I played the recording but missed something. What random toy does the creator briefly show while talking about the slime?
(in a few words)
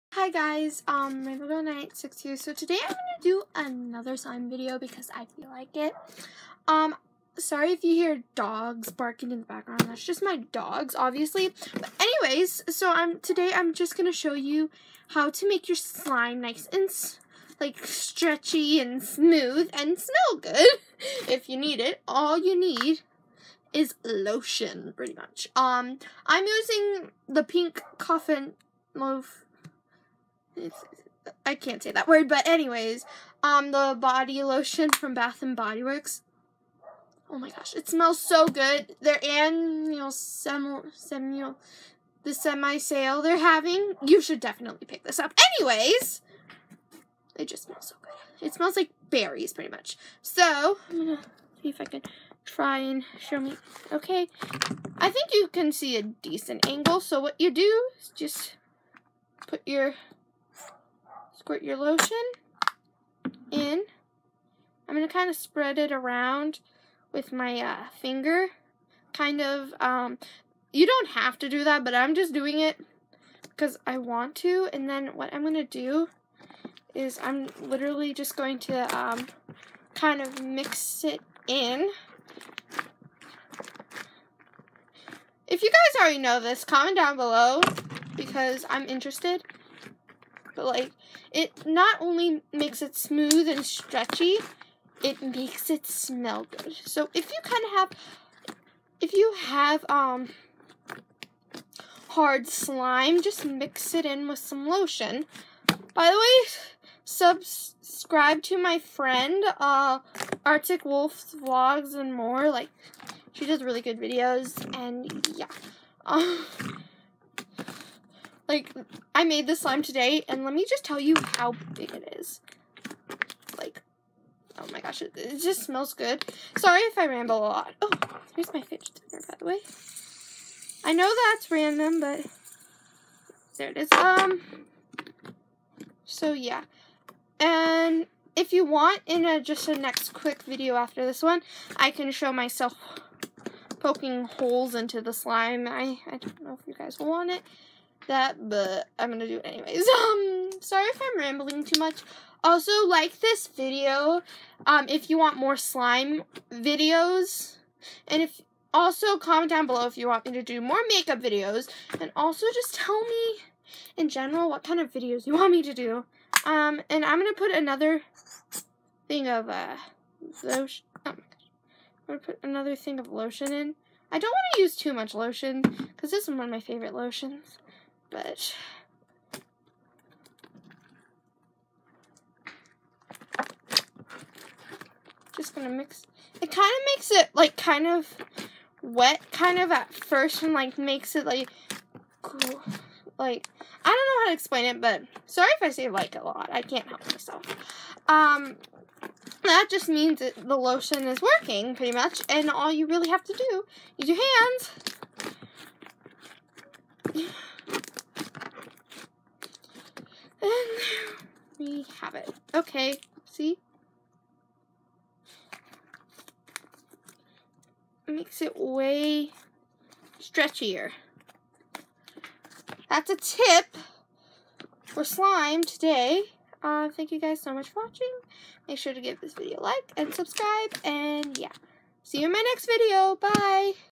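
Fidget spinner.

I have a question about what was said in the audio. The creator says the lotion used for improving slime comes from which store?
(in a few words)
Bath and Body Works.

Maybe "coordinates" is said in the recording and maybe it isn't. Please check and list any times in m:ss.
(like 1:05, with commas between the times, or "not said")
not said.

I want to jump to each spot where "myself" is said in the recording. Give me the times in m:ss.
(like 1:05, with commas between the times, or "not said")
2:22, 3:17.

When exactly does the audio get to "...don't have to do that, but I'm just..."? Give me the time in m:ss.
1:10.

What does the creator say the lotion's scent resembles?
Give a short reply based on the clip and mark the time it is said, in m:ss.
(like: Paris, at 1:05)
Berries, at 0:49.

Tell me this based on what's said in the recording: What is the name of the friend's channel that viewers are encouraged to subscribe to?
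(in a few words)
Arctic Wolf Vlogs and more.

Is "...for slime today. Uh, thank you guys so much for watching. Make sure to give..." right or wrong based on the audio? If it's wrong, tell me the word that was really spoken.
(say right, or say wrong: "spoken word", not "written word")
right.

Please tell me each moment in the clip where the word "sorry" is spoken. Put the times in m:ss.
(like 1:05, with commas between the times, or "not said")
0:07, 2:06, 2:30, 3:15.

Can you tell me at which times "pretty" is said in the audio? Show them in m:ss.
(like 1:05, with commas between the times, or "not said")
0:24, 0:49, 3:21.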